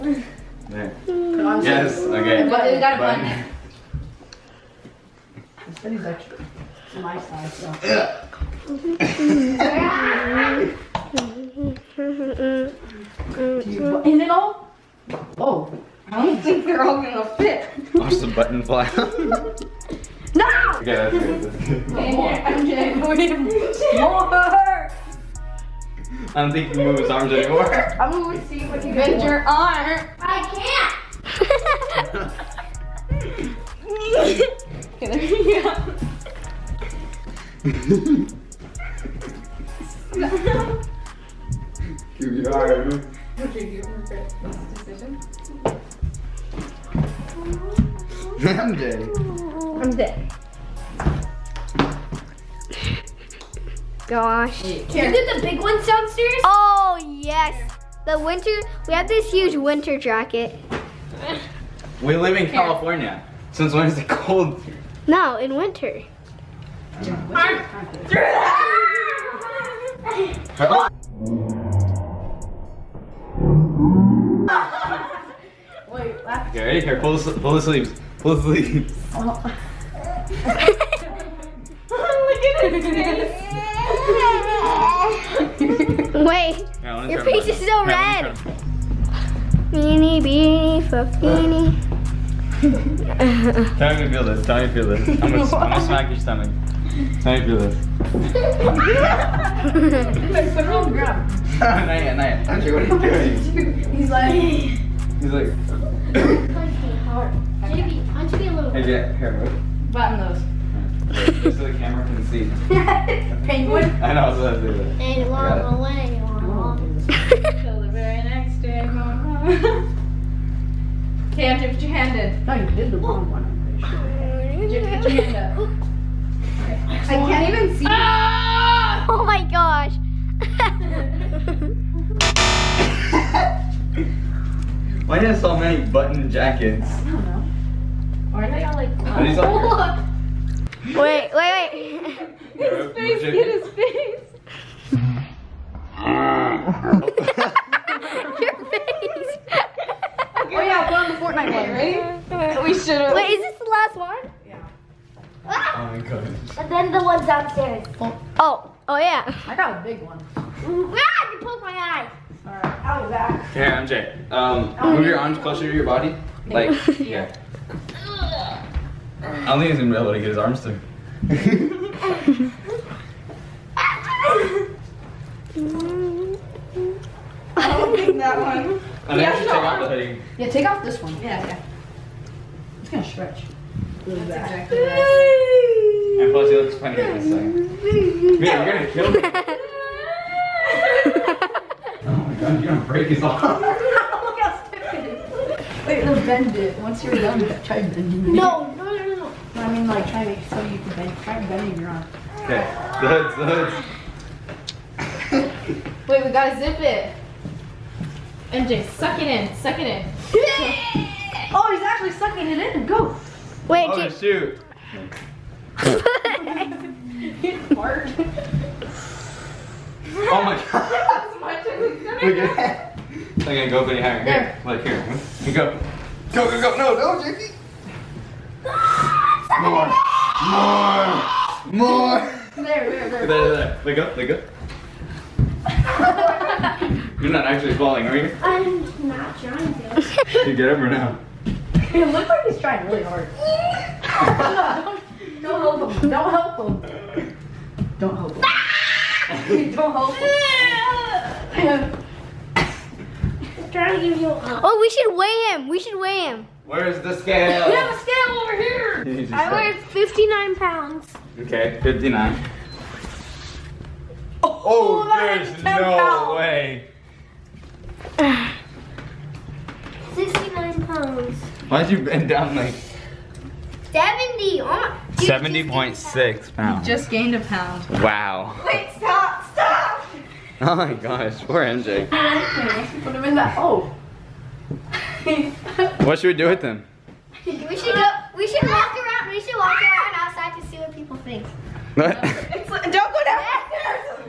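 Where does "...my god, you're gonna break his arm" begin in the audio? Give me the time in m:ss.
3:12.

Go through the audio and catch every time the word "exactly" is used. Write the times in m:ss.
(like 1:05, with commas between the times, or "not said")
3:04.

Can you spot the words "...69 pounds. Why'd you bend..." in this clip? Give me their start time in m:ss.
4:30.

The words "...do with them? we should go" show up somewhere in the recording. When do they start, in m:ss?
4:46.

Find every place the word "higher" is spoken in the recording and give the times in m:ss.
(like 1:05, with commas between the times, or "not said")
3:43.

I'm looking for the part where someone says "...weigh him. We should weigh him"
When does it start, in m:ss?
4:15.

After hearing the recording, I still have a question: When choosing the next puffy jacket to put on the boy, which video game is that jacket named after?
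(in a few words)
Fortnite.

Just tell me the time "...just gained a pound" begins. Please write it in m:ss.
4:36.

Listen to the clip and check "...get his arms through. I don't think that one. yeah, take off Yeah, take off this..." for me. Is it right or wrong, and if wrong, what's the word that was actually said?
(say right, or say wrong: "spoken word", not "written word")
right.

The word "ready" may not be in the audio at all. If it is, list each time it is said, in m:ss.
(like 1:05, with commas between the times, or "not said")
1:16, 2:31.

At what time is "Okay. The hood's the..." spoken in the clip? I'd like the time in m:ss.
3:22.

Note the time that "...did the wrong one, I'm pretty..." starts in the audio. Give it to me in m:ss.
2:02.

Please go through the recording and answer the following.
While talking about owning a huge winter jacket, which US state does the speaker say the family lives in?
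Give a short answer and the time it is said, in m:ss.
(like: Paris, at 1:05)
California, at 1:02.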